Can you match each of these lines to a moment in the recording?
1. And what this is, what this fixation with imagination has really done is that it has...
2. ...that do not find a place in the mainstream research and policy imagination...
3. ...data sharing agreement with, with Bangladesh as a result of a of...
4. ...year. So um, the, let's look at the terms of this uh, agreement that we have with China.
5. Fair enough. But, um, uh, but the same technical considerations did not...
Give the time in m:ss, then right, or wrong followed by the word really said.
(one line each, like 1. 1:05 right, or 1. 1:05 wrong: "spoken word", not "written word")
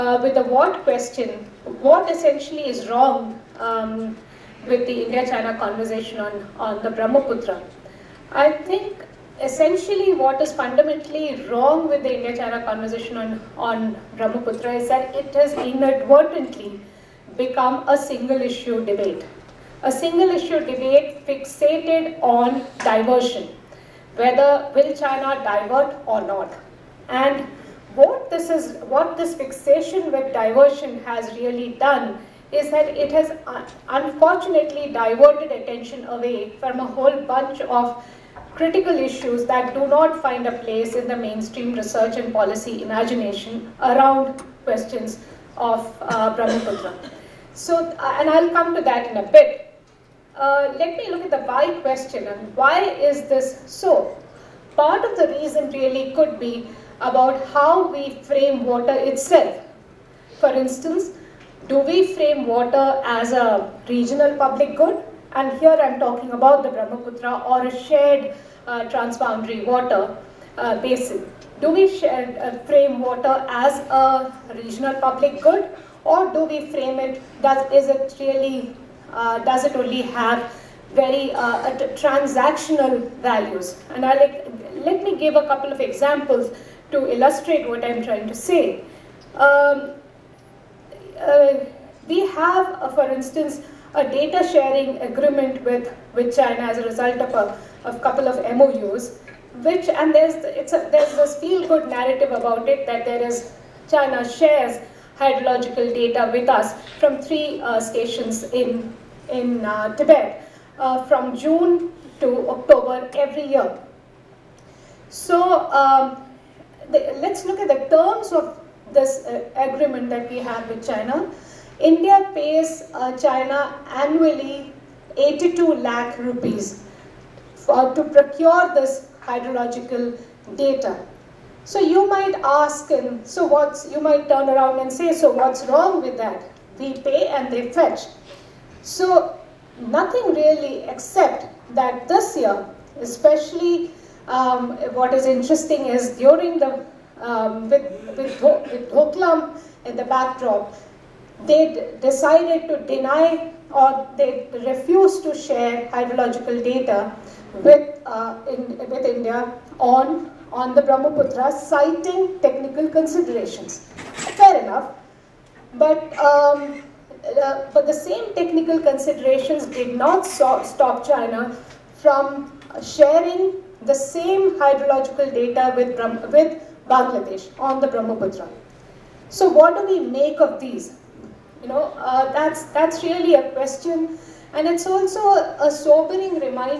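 1. 0:27 wrong: "diversion", not "imagination"
2. 0:39 right
3. 1:34 wrong: "China", not "Bangladesh"
4. 1:53 right
5. 2:44 right.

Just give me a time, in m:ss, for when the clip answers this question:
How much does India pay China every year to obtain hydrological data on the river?
2:05.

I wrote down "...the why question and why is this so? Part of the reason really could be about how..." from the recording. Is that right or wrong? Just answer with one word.
right.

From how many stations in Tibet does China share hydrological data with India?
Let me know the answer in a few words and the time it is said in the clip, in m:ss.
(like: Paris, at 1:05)
3, at 1:47.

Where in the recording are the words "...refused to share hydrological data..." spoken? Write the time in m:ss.
2:34.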